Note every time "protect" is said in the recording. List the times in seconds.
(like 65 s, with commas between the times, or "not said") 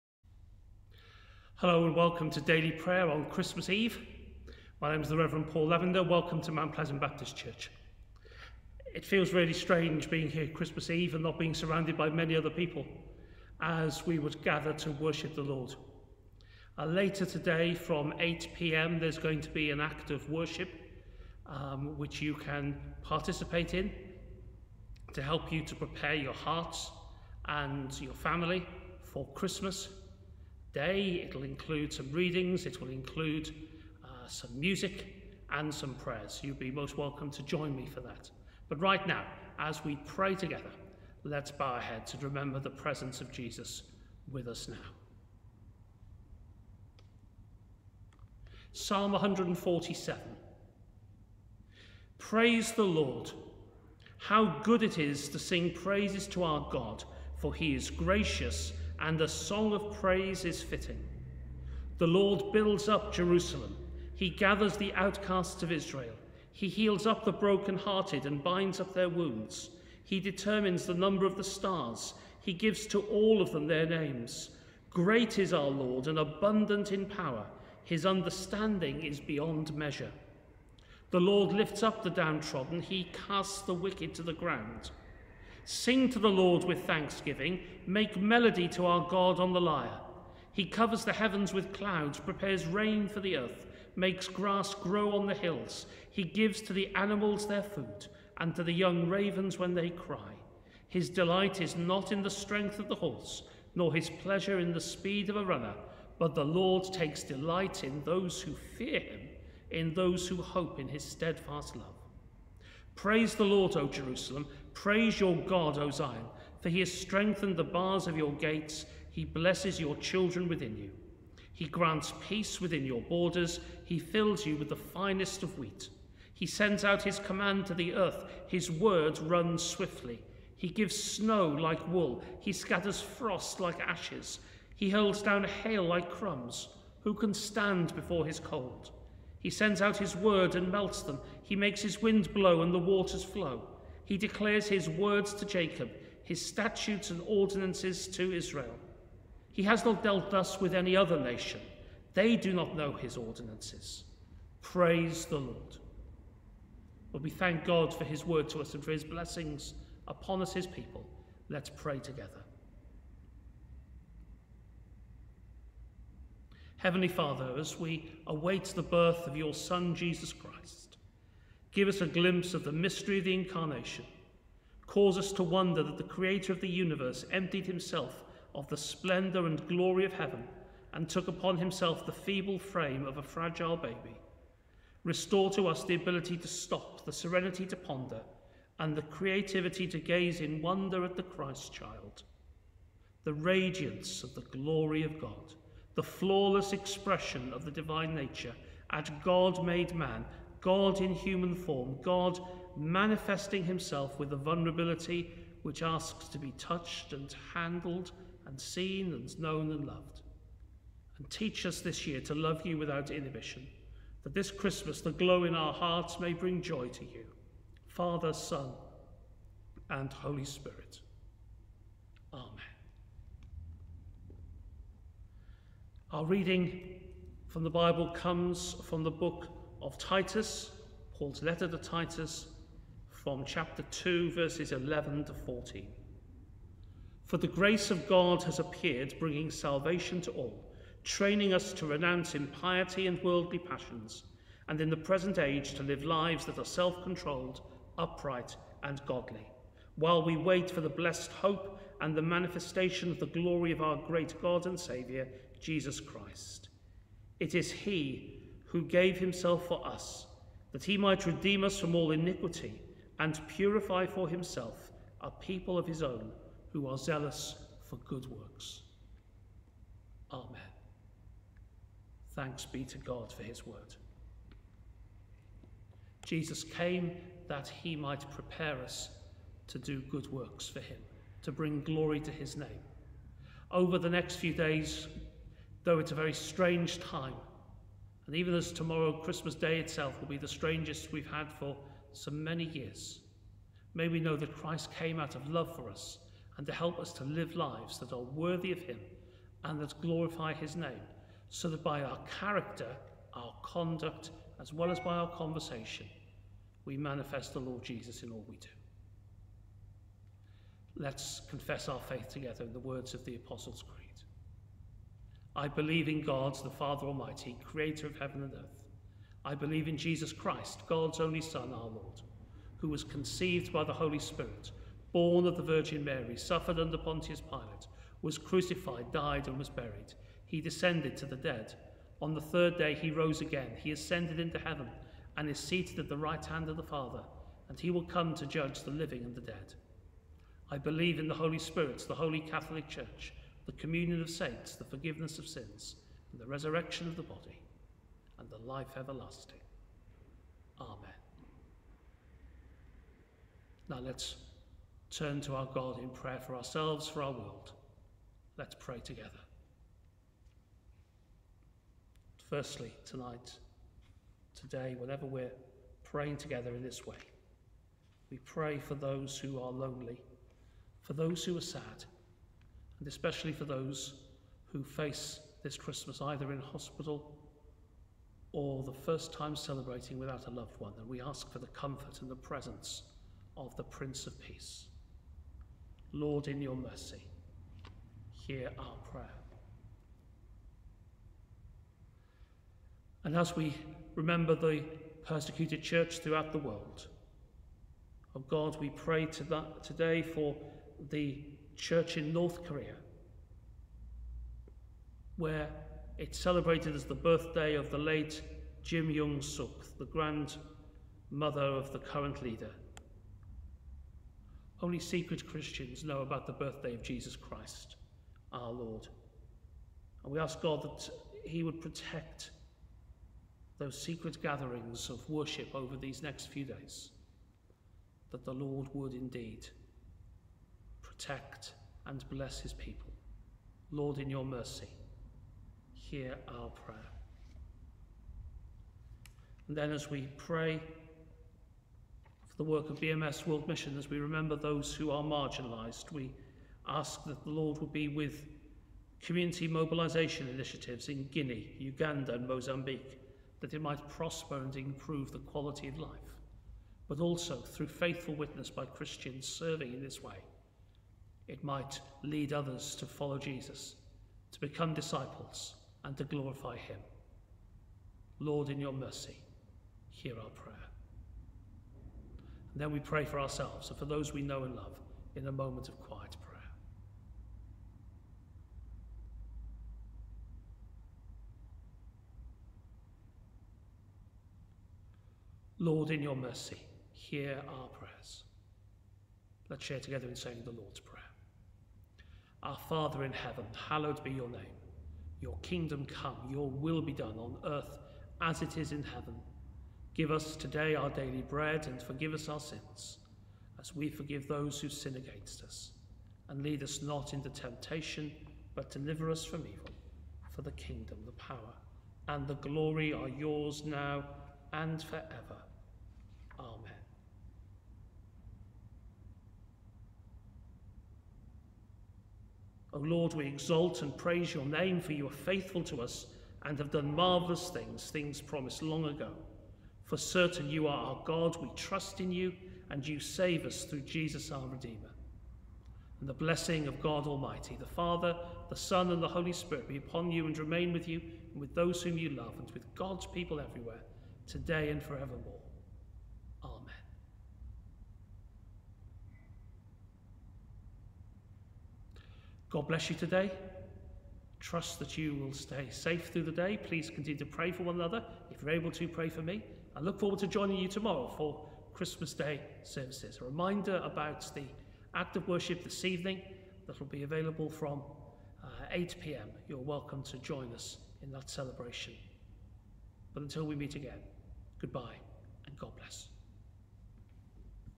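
421 s, 431 s.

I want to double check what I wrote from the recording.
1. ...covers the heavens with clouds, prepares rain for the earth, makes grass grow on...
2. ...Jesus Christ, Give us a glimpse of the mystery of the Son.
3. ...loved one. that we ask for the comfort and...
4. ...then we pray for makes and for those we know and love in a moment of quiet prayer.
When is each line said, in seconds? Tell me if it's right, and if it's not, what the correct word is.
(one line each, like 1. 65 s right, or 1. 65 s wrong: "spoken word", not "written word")
1. 90 s right
2. 169 s wrong: "Incarnation", not "Son"
3. 380 s right
4. 472 s wrong: "ourselves", not "makes".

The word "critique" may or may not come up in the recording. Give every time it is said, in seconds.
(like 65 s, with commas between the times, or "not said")
not said.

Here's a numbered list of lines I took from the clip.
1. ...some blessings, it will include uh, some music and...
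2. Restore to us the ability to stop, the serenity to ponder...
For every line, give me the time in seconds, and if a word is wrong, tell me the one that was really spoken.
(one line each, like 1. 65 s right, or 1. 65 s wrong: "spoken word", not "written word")
1. 31 s wrong: "readings", not "blessings"
2. 185 s right.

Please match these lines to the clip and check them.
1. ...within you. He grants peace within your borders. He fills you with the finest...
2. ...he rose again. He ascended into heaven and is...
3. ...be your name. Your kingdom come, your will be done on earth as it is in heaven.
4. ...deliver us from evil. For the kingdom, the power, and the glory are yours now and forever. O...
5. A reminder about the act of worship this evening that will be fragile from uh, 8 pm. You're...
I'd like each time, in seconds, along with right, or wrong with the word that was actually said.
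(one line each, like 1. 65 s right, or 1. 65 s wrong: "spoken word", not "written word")
1. 120 s right
2. 332 s right
3. 494 s right
4. 508 s right
5. 563 s wrong: "available", not "fragile".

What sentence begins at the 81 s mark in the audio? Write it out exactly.
The Lord lifts up the downtrodden.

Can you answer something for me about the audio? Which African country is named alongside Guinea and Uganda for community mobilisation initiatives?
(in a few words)
Mozambique.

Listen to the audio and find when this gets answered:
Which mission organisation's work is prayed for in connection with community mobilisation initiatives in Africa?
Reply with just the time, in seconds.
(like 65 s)
442 s.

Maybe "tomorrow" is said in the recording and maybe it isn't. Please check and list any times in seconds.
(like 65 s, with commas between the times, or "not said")
288 s, 560 s.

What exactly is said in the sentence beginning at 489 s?
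Let's share together in saying the Lord's Prayer.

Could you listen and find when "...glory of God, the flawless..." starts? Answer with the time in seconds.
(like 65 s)
194 s.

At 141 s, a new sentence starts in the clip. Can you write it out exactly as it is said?
He makes his wind blow and the waters flow.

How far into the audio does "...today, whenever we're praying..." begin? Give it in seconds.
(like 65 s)
364 s.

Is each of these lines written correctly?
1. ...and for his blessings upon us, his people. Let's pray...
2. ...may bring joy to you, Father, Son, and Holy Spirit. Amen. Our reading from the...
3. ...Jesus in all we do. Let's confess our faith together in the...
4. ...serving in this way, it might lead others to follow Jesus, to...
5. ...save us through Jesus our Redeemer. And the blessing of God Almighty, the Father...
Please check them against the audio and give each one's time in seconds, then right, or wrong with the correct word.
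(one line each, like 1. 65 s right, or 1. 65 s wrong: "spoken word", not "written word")
1. 158 s right
2. 216 s right
3. 307 s right
4. 459 s right
5. 533 s right.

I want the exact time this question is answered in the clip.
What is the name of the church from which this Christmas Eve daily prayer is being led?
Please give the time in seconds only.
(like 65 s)
6 s.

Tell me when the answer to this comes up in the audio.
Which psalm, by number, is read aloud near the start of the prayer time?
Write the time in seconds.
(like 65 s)
48 s.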